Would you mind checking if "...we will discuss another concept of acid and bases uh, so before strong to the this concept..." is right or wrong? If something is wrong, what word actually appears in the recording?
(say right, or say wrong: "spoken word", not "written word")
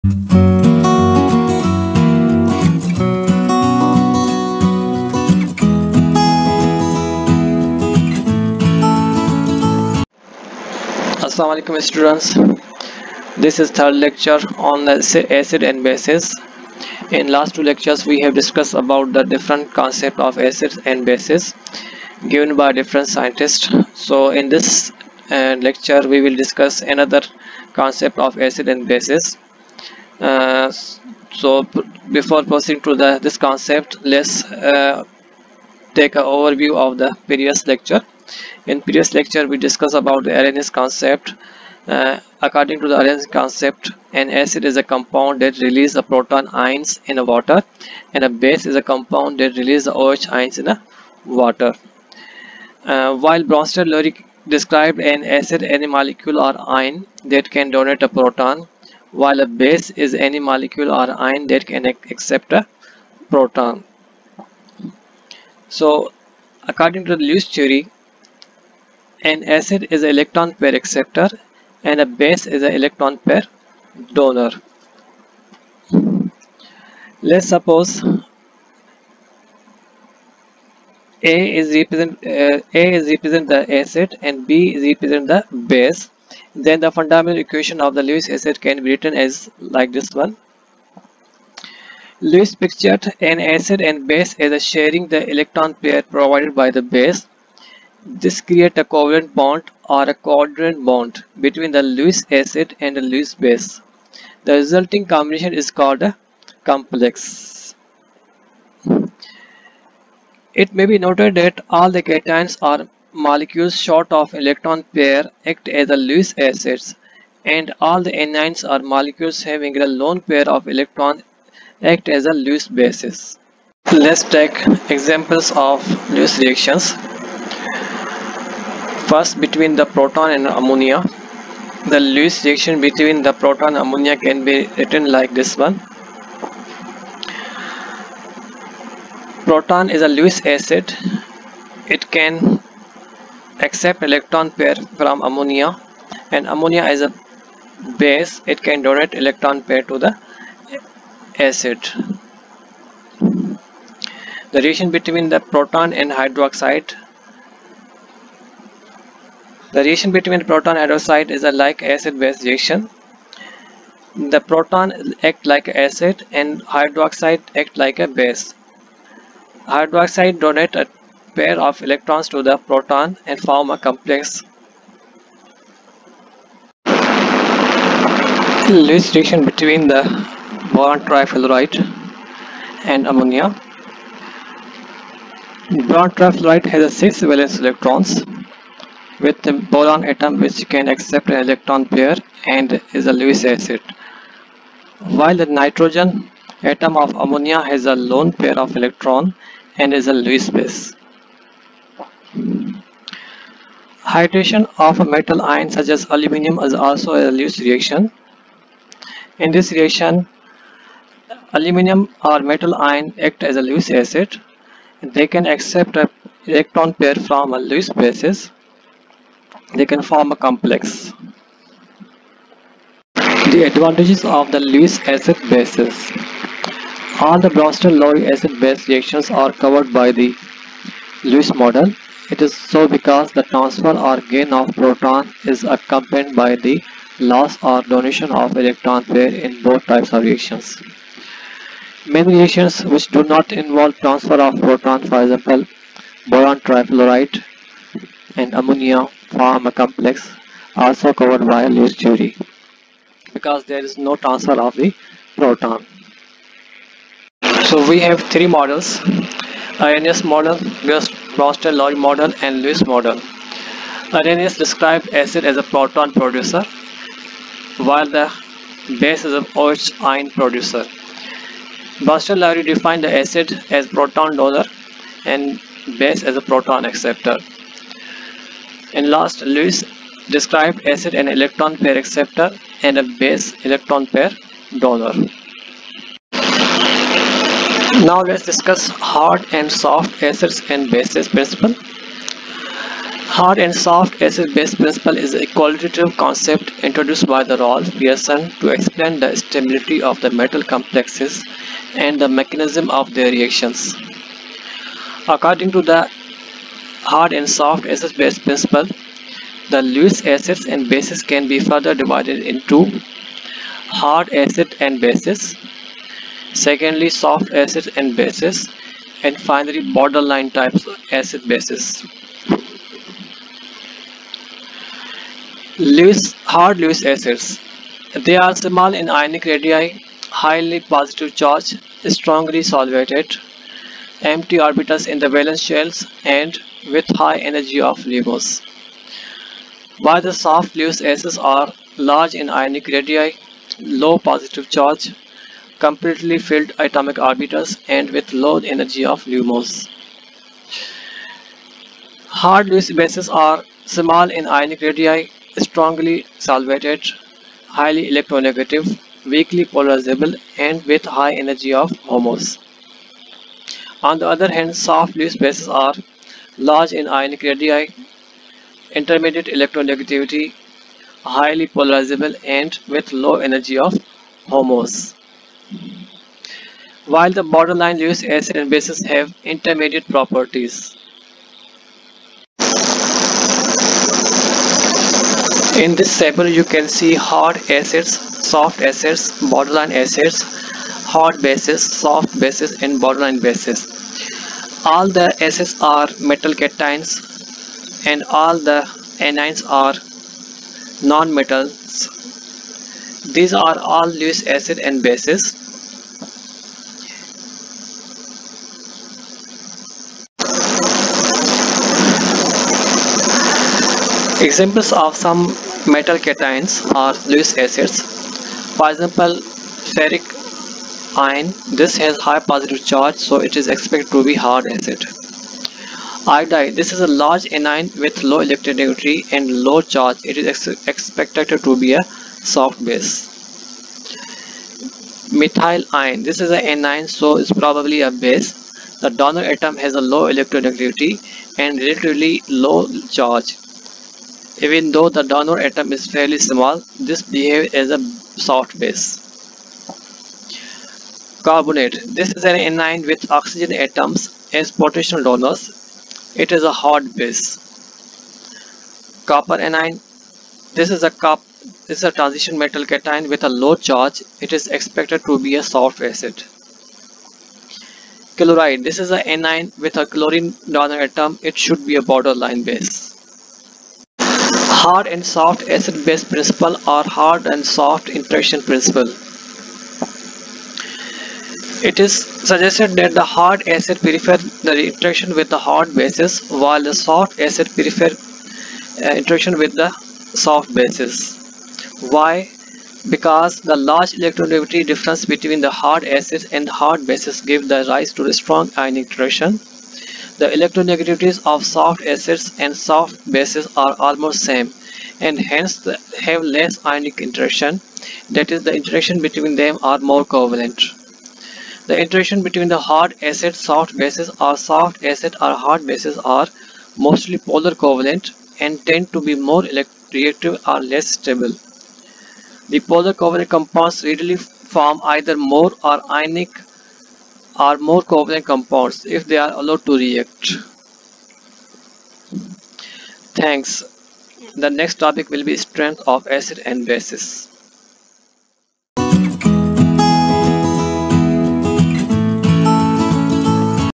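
wrong: "proceeding", not "strong".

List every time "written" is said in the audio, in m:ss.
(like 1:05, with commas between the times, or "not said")
1:28, 2:14.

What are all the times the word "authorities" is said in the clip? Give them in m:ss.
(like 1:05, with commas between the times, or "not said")
not said.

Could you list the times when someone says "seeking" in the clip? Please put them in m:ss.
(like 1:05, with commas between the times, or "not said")
not said.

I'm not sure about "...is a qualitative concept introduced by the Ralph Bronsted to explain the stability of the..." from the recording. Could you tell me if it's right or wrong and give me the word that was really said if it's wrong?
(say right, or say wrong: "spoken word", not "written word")
wrong: "Pearson", not "Bronsted".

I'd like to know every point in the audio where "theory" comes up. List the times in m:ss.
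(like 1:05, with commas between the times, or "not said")
1:07, 4:12.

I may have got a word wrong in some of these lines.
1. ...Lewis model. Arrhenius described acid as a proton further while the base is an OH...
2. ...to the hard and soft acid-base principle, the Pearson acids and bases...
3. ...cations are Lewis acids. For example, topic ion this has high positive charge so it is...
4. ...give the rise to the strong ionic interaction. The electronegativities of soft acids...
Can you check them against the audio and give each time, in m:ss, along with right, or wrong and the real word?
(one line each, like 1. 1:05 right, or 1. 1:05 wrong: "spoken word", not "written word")
1. 4:22 wrong: "producer", not "further"
2. 5:05 wrong: "Lewis", not "Pearson"
3. 6:56 wrong: "ferric", not "topic"
4. 8:17 right.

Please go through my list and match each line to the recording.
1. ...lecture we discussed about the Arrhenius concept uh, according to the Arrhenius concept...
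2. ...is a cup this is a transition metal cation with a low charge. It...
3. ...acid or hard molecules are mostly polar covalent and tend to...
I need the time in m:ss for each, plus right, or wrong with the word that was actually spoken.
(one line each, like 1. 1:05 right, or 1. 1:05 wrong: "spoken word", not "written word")
1. 0:39 right
2. 7:40 right
3. 8:35 wrong: "bases", not "molecules".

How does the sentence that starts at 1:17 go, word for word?
Let's suppose A is represent uh, A is represent the acid and B is represent the base.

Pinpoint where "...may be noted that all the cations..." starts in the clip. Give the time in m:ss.
1:50.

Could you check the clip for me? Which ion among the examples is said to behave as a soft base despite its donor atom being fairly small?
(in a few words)
Methyl ion.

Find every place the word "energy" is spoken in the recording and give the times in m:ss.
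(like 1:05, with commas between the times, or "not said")
5:37, 5:48, 6:01, 6:13.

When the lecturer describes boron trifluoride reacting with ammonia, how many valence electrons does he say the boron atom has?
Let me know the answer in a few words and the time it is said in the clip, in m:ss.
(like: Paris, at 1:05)
6, at 3:06.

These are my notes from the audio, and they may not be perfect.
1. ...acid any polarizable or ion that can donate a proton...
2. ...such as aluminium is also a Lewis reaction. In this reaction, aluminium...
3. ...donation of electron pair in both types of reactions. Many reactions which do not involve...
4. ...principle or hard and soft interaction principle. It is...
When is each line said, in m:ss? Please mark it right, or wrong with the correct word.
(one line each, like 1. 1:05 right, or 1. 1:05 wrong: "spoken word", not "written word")
1. 0:55 wrong: "molecule", not "polarizable"
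2. 3:25 right
3. 3:57 right
4. 7:56 right.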